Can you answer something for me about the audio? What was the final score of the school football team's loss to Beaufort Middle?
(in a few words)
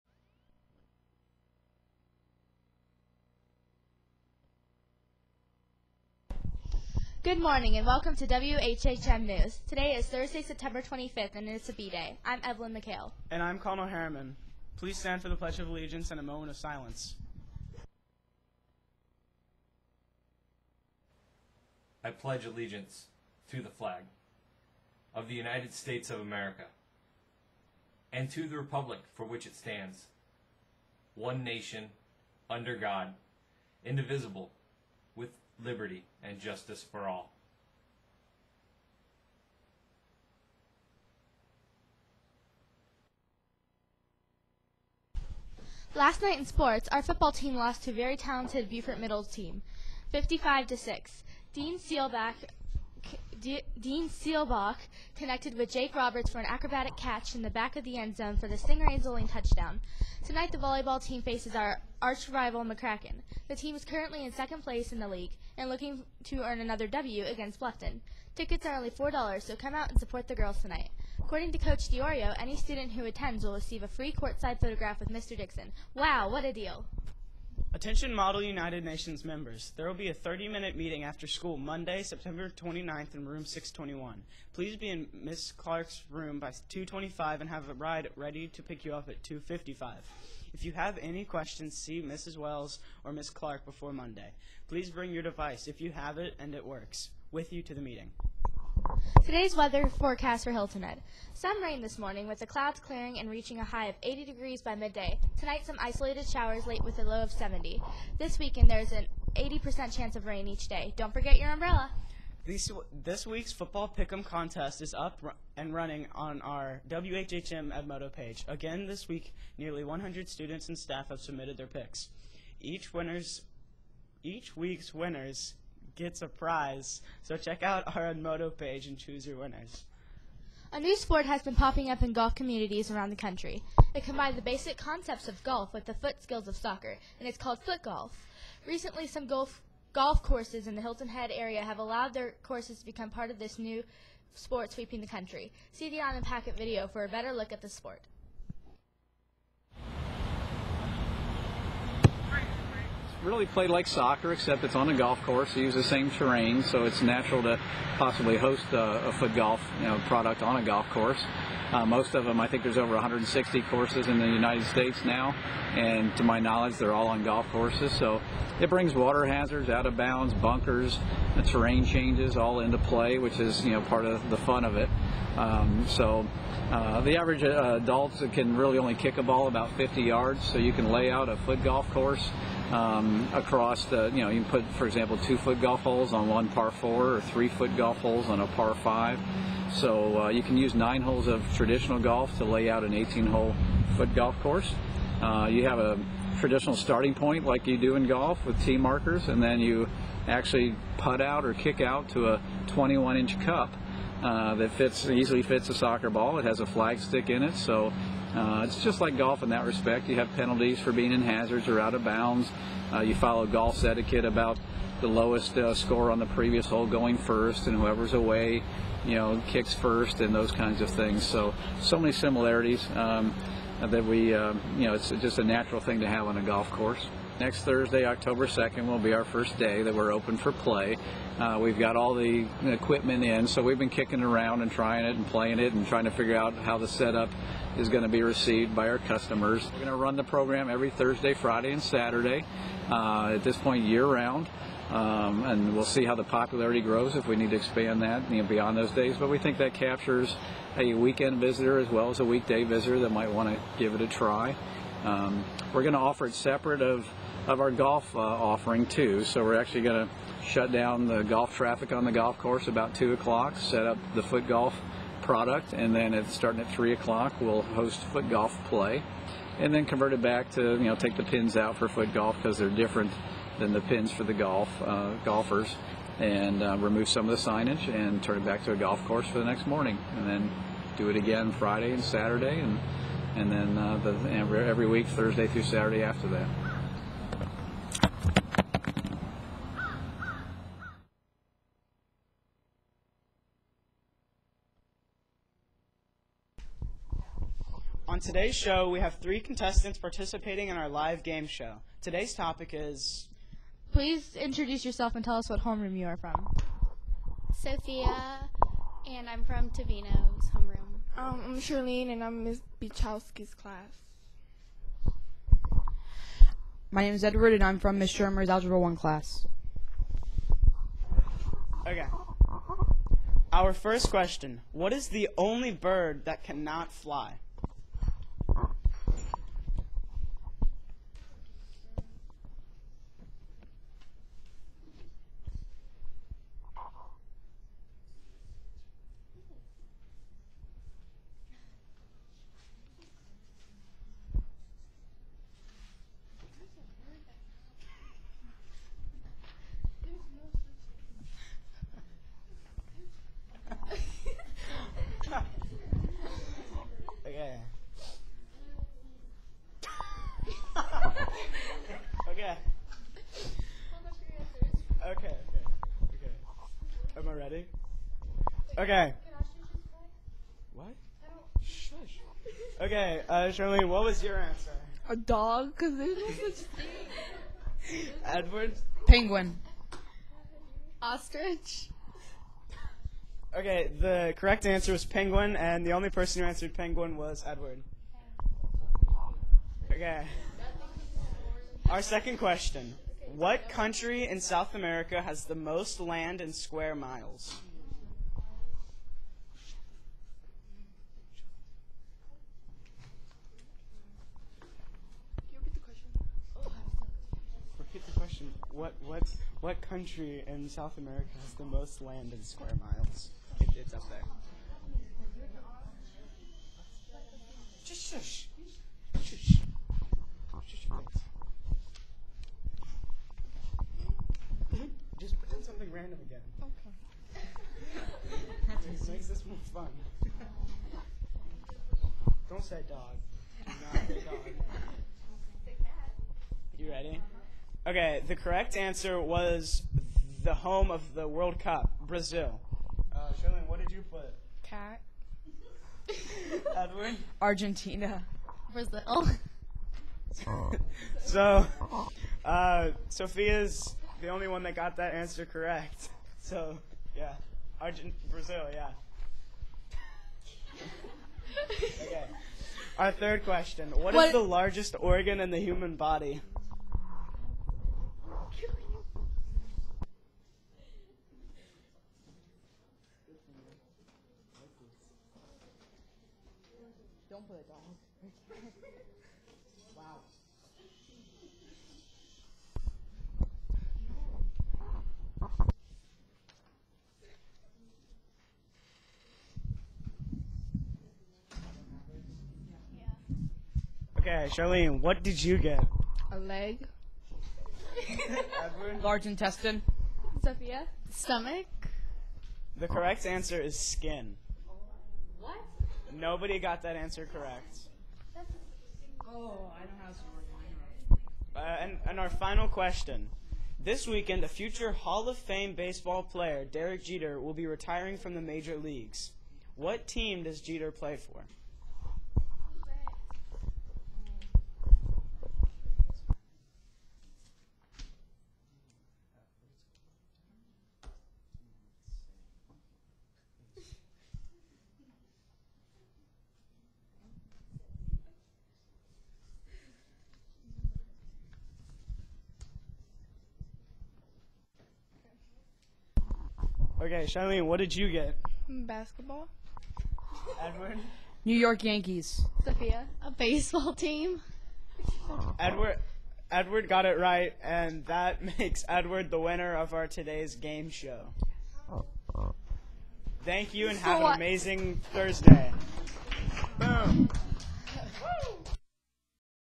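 55 to 6.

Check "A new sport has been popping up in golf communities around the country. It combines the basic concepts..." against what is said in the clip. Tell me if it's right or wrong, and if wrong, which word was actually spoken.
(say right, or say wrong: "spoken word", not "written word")
right.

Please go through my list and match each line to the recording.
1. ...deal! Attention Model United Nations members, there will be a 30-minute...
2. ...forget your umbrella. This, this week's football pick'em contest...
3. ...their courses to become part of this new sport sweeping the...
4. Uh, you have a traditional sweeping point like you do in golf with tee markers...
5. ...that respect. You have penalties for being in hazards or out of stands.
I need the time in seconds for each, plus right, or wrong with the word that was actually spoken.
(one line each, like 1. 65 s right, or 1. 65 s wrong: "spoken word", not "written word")
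1. 76 s right
2. 111 s right
3. 142 s right
4. 195 s wrong: "starting", not "sweeping"
5. 209 s wrong: "bounds", not "stands".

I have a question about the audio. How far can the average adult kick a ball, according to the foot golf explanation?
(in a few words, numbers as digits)
50 yards.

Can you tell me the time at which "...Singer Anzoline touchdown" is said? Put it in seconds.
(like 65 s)
58 s.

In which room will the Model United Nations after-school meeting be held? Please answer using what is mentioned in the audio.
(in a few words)
621.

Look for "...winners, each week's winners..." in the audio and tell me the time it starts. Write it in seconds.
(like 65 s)
122 s.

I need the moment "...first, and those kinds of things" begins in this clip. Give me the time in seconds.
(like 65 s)
219 s.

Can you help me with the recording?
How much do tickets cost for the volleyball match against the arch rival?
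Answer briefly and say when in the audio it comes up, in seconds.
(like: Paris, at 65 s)
$4, at 68 s.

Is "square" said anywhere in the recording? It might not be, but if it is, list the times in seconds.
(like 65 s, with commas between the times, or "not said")
396 s, 412 s.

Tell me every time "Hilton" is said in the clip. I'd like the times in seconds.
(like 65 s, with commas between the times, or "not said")
100 s, 140 s.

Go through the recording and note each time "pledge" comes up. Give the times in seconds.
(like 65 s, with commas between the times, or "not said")
15 s, 22 s.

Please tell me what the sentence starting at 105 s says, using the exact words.
Tonight some isolated showers late with a low of 70.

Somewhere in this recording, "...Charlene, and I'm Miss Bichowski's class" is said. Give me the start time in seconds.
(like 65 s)
311 s.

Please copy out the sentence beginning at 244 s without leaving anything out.
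Um, and we'll see how the popularity grows if we need to expand that you know, beyond those days.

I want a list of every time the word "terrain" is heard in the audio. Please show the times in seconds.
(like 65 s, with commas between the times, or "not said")
156 s, 171 s.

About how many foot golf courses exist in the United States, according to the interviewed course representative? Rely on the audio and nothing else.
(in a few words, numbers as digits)
over 160.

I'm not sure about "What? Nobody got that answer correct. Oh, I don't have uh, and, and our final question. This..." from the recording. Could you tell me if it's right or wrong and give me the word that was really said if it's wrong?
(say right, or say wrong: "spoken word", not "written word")
right.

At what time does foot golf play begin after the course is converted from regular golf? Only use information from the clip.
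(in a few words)
3 o'clock.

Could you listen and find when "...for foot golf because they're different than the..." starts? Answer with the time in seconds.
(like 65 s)
271 s.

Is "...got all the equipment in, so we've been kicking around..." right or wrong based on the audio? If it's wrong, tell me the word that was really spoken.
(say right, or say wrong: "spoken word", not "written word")
right.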